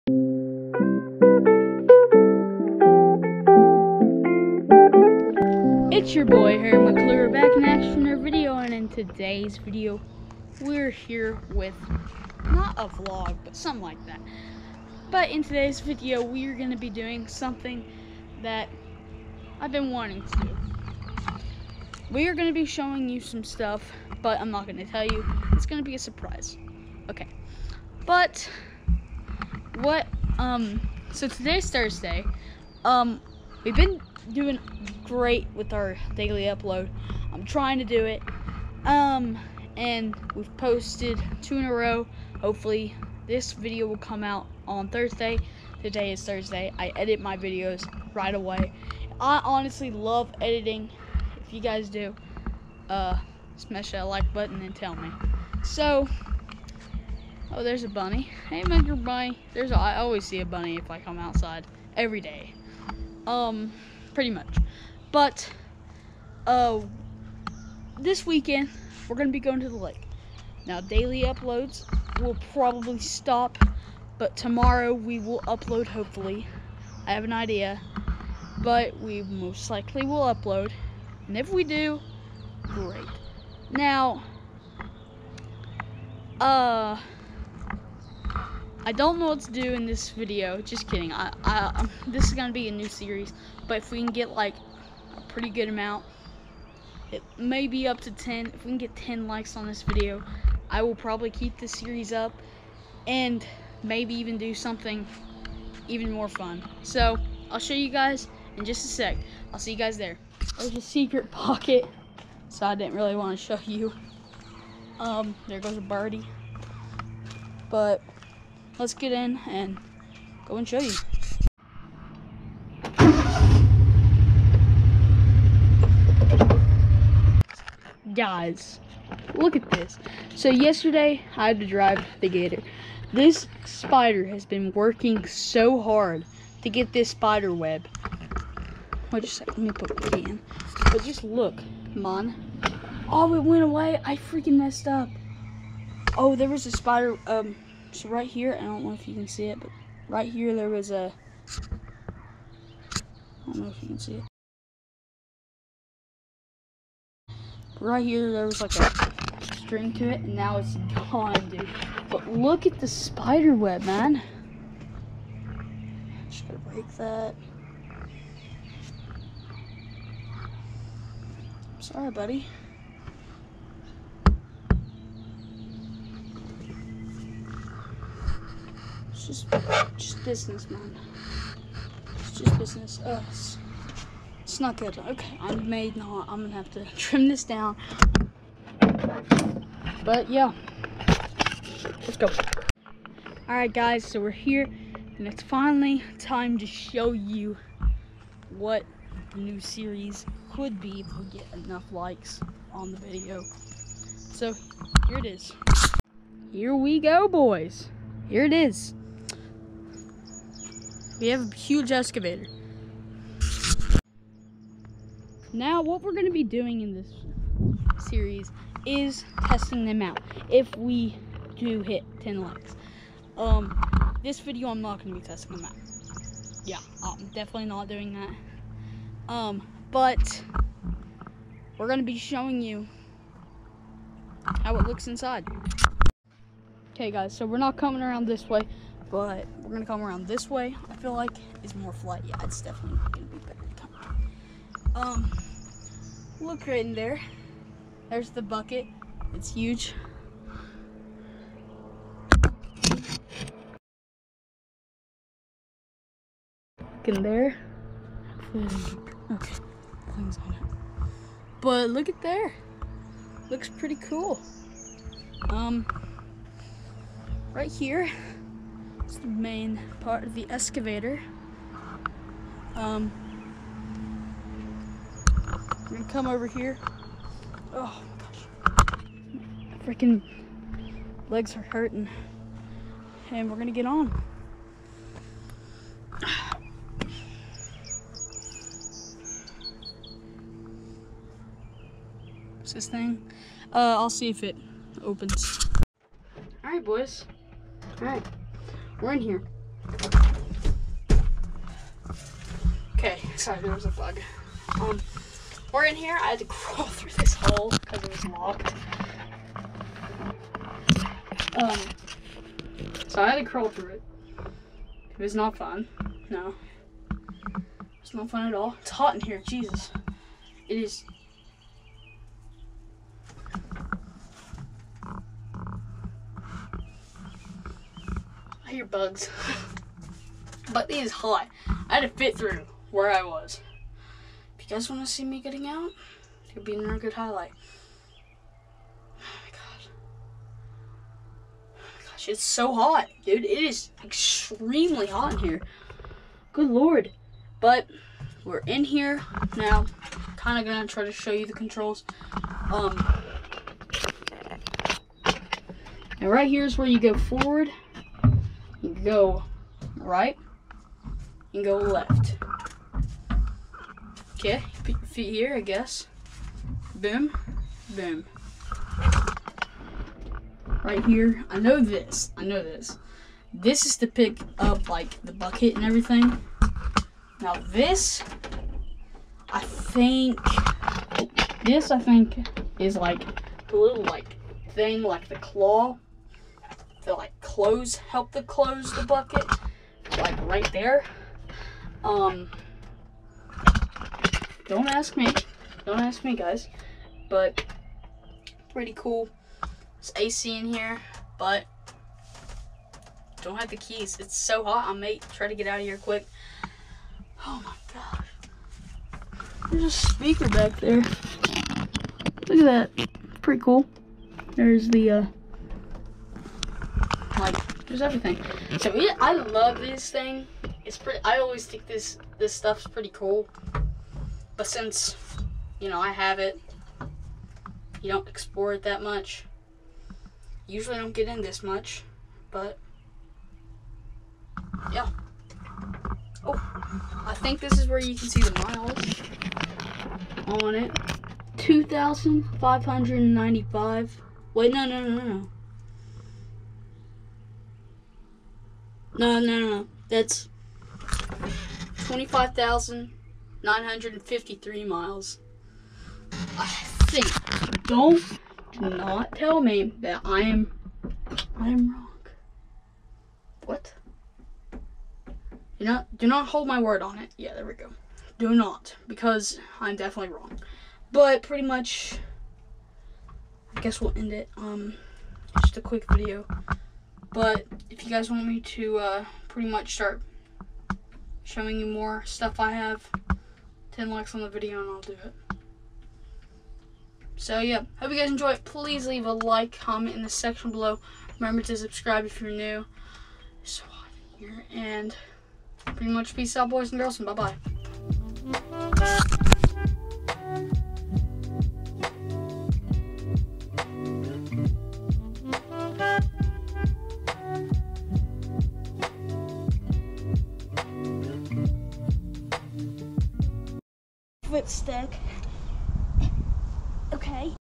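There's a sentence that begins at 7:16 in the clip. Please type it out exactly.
Oh, I think this is where you can see the miles on it.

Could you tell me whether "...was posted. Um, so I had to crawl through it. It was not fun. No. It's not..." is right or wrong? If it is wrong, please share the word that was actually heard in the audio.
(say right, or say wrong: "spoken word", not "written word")
wrong: "locked", not "posted".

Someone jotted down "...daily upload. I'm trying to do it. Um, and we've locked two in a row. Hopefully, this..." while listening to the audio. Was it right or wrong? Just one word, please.
wrong.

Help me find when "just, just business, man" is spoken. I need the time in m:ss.
2:59.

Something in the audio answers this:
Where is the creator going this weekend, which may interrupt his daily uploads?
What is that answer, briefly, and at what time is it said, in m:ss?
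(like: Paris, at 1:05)
the lake, at 1:09.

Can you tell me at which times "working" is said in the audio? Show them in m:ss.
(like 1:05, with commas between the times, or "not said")
2:14.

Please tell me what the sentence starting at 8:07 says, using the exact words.
So yeah, hope you guys enjoy it.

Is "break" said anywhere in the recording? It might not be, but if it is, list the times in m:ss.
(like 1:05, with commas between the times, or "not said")
2:46.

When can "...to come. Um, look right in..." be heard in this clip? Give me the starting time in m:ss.
4:03.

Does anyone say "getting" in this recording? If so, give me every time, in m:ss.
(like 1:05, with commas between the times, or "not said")
5:35.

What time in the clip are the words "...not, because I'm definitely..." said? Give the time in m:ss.
7:48.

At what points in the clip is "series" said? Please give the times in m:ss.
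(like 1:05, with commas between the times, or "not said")
1:32, 1:41, 3:19, 3:38.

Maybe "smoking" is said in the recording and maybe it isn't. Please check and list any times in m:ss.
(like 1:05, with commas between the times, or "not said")
not said.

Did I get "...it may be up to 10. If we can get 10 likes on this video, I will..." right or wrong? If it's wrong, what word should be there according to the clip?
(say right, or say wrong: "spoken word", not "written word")
right.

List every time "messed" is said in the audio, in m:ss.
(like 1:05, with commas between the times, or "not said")
2:24.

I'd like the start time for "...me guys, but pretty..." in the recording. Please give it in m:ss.
6:36.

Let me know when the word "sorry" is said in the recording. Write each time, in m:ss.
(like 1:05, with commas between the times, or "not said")
2:51, 5:03.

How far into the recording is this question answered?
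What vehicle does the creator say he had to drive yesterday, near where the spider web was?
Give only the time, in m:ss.
2:12.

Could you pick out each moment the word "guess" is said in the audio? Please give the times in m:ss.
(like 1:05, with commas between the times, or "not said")
6:05, 7:53.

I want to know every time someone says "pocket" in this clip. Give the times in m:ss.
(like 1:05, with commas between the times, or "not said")
1:51.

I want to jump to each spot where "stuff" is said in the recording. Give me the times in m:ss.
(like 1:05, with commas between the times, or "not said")
0:23, 7:02, 8:02.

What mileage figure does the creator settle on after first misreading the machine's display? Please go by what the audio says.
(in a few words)
25,953 miles.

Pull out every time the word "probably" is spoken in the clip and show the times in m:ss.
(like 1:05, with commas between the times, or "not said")
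1:12, 1:40.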